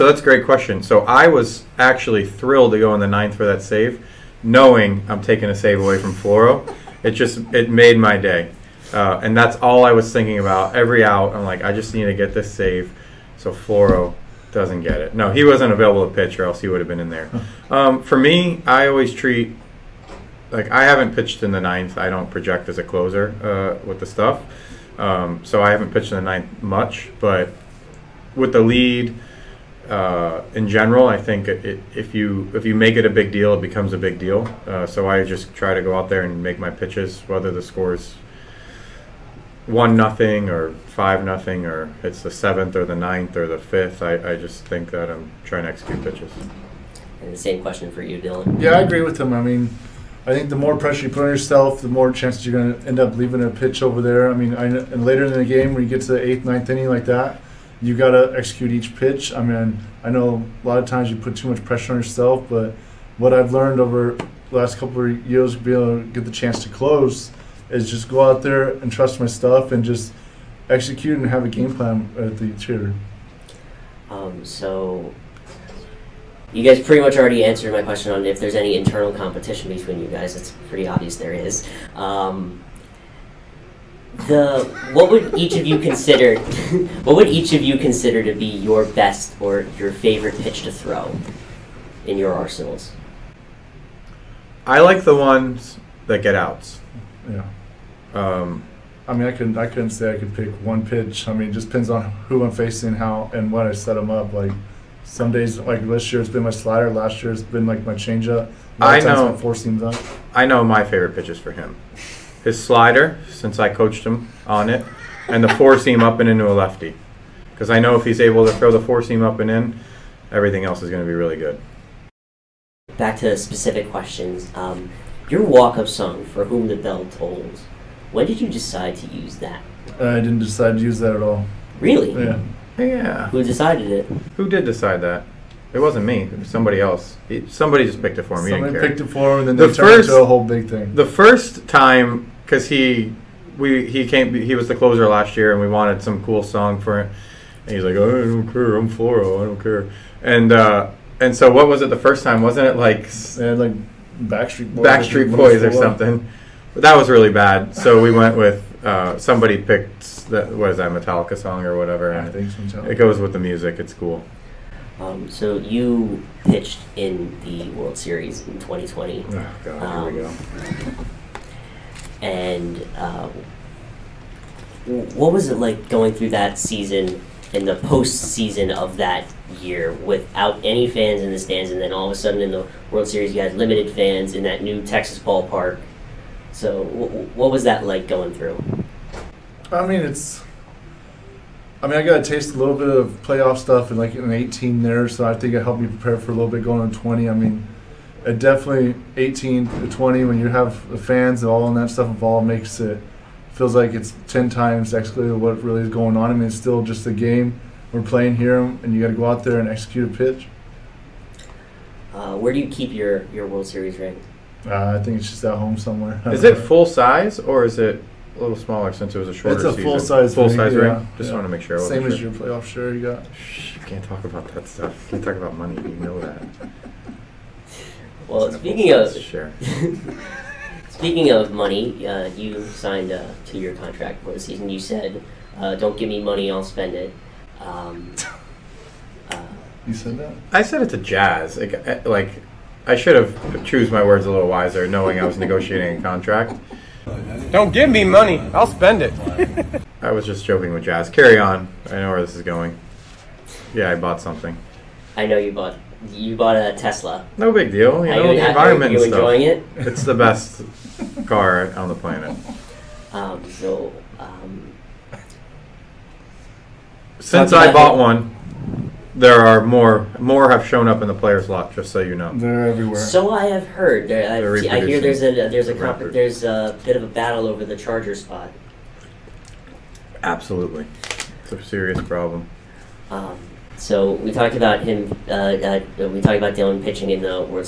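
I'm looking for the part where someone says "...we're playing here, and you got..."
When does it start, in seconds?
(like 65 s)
207 s.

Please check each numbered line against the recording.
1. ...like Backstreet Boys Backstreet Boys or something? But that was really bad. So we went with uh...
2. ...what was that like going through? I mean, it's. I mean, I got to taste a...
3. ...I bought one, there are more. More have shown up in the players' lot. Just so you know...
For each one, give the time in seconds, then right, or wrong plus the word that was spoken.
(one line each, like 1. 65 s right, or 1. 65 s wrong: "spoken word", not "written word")
1. 153 s right
2. 187 s right
3. 267 s right.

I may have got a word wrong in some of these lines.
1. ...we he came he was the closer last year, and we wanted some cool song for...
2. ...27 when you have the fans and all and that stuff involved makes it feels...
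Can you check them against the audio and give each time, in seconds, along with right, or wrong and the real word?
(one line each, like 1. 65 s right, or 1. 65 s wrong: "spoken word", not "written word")
1. 143 s right
2. 199 s wrong: "20", not "27".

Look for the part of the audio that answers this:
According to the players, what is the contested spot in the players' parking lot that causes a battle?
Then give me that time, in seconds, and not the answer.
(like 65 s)
277 s.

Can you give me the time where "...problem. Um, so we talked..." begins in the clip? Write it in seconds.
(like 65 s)
282 s.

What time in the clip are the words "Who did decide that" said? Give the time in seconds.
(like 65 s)
134 s.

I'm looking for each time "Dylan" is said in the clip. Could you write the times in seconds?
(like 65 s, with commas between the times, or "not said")
48 s, 286 s.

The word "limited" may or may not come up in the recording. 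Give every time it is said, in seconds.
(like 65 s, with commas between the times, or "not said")
183 s.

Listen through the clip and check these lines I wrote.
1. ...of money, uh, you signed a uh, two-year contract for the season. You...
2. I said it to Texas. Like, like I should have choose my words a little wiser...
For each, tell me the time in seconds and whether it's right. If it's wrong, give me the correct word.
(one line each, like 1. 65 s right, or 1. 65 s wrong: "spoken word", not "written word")
1. 231 s right
2. 240 s wrong: "Jazz", not "Texas".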